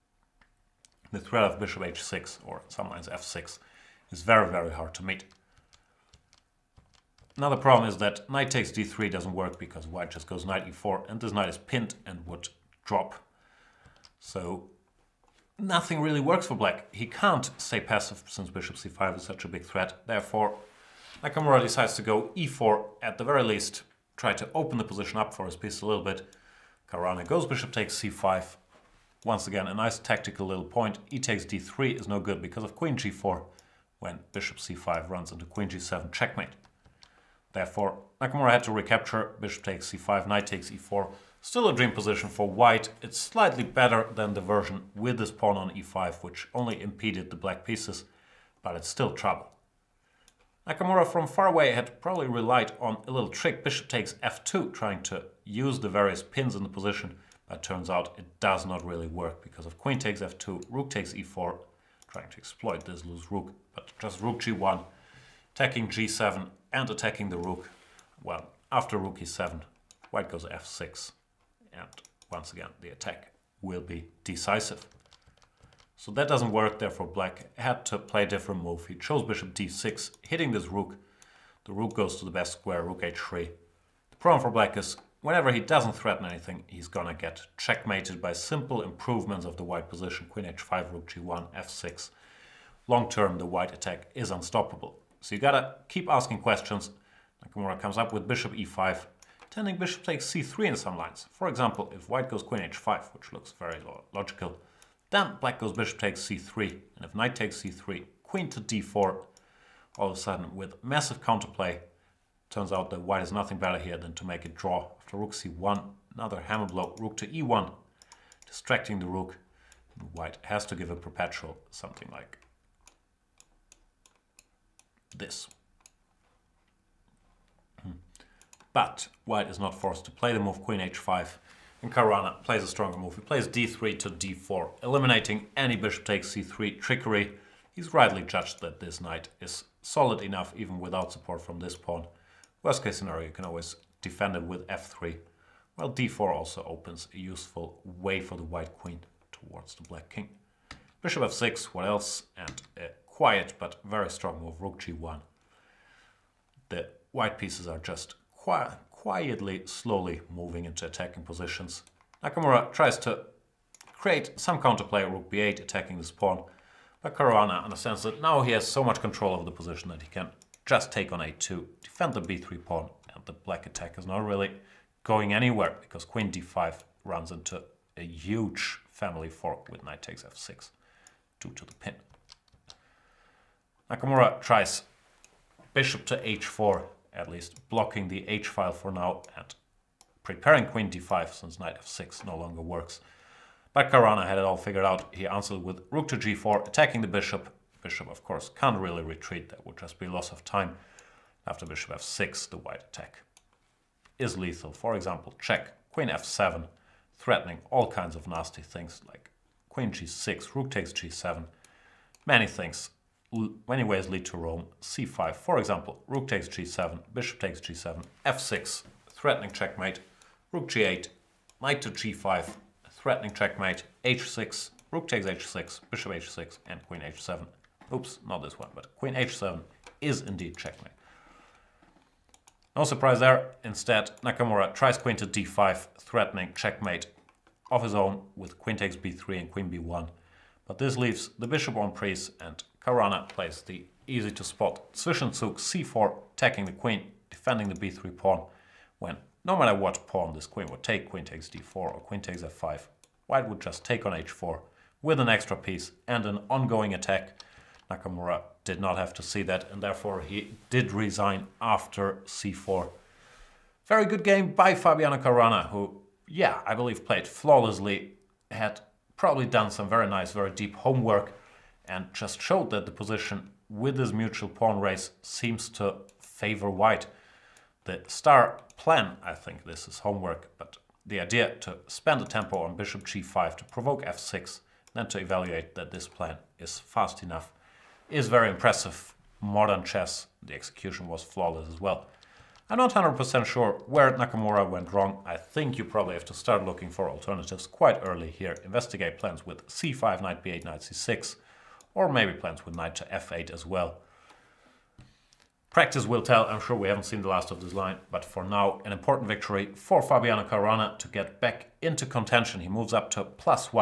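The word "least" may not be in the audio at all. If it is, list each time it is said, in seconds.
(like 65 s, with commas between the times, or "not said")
23 s, 187 s.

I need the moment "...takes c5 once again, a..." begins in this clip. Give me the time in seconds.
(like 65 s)
27 s.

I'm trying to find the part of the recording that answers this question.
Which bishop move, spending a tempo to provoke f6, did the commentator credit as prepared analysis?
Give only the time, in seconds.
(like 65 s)
282 s.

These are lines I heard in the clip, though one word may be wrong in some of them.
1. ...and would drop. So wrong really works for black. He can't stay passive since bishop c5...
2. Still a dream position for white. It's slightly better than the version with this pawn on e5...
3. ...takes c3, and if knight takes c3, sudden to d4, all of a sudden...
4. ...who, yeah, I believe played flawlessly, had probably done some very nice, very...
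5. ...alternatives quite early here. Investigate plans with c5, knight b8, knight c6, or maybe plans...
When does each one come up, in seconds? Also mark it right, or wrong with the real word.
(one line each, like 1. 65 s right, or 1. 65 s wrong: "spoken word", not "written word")
1. 12 s wrong: "nothing", not "wrong"
2. 41 s right
3. 105 s wrong: "queen", not "sudden"
4. 265 s right
5. 297 s right.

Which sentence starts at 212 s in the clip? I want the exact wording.
Many things, many ways lead to Rome.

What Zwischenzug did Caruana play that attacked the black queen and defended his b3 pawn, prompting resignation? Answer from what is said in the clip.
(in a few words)
c4.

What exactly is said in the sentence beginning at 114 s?
After rook c1, another hammer blow, rook to e1, distracting the rook.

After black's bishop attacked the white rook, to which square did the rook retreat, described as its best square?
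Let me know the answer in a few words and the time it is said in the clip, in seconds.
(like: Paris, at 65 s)
h3, at 82 s.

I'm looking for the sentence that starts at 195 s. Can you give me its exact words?
He answered with rook to g4, attacking the bishop, bishop, of course, can't really retreat.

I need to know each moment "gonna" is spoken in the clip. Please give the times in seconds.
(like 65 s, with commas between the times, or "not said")
86 s.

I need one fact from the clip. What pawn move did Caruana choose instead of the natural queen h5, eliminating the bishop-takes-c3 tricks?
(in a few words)
d4.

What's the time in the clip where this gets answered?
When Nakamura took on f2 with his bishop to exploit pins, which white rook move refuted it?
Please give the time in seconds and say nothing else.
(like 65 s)
64 s.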